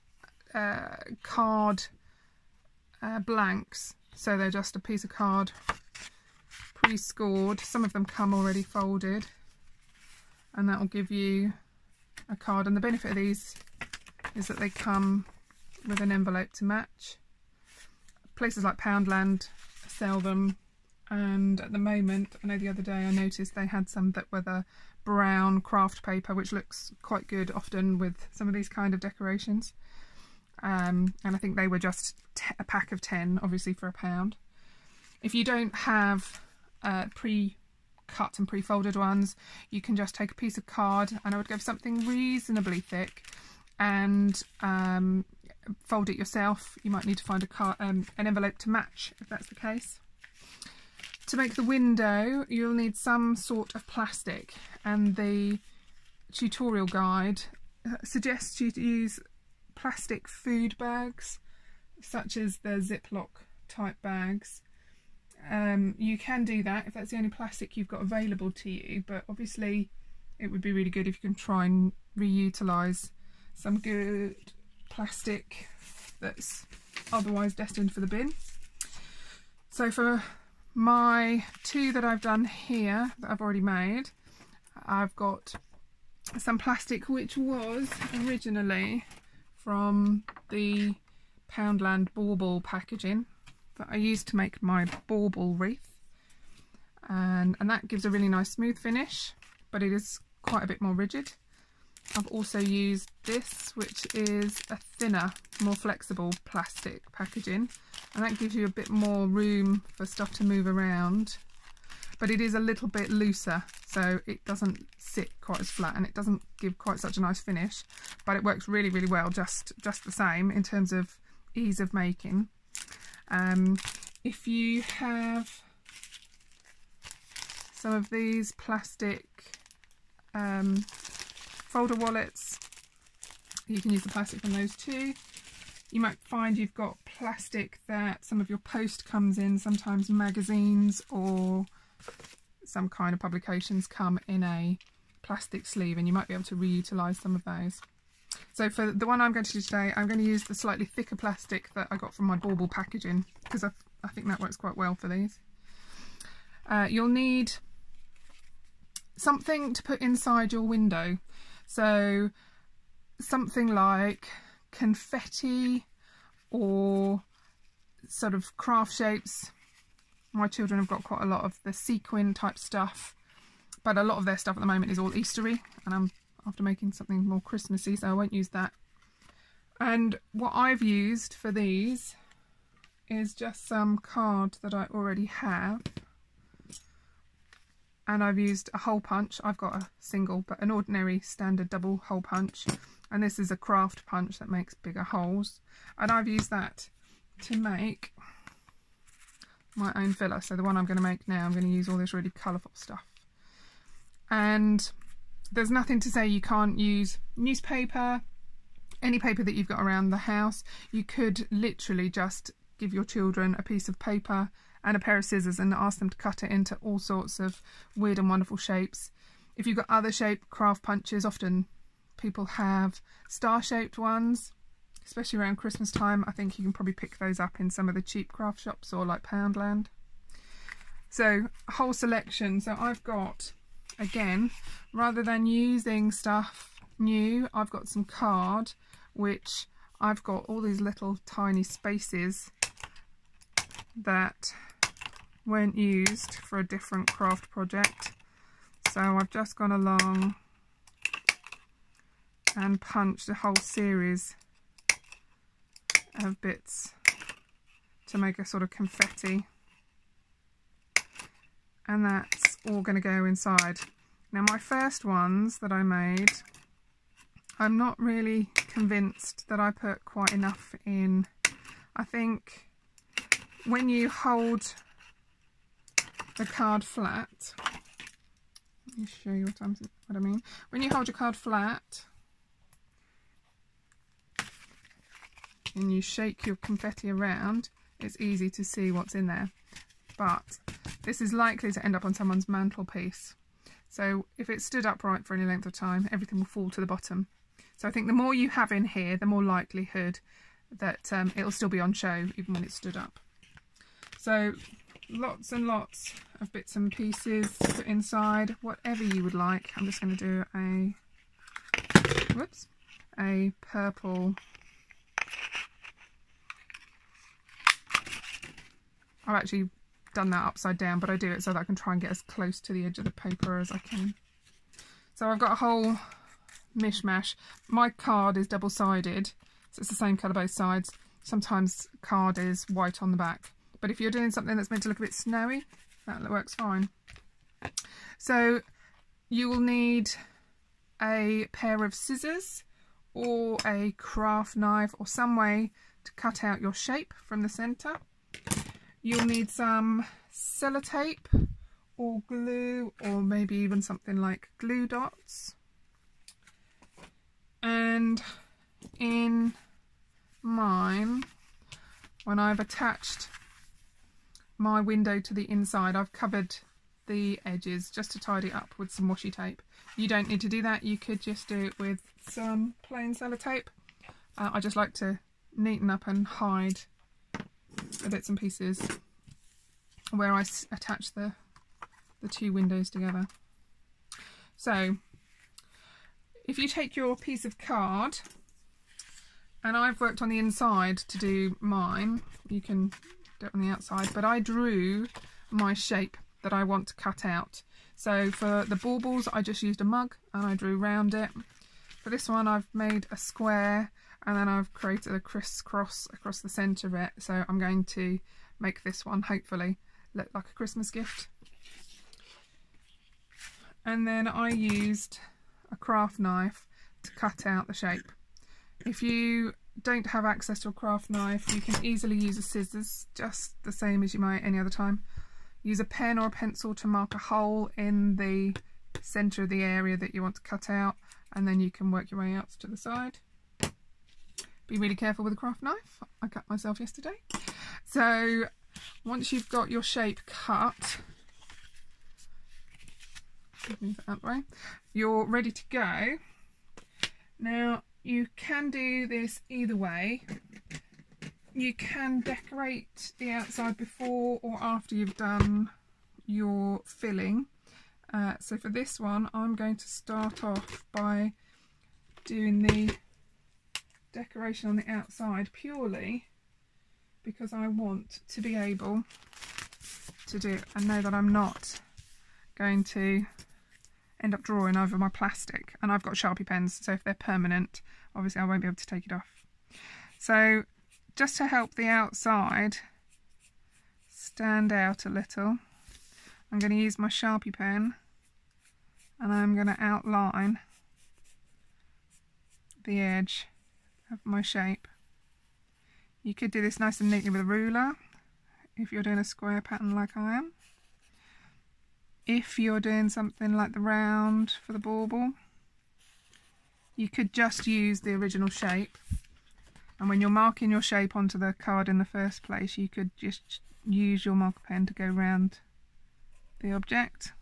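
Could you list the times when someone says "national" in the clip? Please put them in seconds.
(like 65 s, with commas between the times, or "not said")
not said.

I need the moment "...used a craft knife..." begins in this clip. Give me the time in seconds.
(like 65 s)
414 s.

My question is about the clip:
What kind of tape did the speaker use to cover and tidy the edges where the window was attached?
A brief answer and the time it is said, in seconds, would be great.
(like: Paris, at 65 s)
washi tape, at 369 s.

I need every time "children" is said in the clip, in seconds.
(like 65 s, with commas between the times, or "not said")
170 s, 213 s.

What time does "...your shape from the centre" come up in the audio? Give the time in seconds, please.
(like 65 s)
346 s.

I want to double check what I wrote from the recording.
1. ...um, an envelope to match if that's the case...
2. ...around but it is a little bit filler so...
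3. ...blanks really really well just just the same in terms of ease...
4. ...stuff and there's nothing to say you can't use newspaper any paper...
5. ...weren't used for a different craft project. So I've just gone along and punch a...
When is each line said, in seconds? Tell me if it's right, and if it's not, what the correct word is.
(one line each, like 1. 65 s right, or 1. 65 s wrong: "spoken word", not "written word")
1. 47 s right
2. 110 s wrong: "looser", not "filler"
3. 118 s wrong: "works", not "blanks"
4. 202 s right
5. 245 s right.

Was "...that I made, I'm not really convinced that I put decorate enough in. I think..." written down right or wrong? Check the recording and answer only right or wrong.
wrong.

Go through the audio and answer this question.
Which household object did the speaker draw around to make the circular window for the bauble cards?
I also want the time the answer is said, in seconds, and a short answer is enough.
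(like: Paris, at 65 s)
a mug, at 399 s.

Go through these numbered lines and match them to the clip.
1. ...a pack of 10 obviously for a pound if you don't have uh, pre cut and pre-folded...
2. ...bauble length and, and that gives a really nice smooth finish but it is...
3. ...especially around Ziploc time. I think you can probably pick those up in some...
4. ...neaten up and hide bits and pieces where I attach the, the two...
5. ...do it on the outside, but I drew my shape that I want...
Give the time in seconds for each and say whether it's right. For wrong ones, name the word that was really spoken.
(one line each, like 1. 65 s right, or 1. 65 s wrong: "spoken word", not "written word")
1. 32 s right
2. 95 s wrong: "wreath", not "length"
3. 225 s wrong: "Christmas", not "Ziploc"
4. 375 s right
5. 393 s right.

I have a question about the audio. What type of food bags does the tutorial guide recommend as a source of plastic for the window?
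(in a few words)
Ziploc.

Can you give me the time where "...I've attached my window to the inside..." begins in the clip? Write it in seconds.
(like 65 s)
362 s.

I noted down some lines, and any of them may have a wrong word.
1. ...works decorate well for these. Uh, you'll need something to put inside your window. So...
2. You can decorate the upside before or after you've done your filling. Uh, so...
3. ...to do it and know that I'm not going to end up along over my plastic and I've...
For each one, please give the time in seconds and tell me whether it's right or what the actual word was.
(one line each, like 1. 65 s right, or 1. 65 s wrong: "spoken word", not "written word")
1. 154 s wrong: "quite", not "decorate"
2. 451 s wrong: "outside", not "upside"
3. 470 s wrong: "drawing", not "along".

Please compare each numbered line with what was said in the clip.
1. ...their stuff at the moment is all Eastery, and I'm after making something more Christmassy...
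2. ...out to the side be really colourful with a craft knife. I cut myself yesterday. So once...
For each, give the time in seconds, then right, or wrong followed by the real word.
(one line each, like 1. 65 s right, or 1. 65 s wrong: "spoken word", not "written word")
1. 174 s right
2. 432 s wrong: "careful", not "colourful".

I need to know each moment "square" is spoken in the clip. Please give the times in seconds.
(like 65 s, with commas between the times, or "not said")
403 s, 499 s.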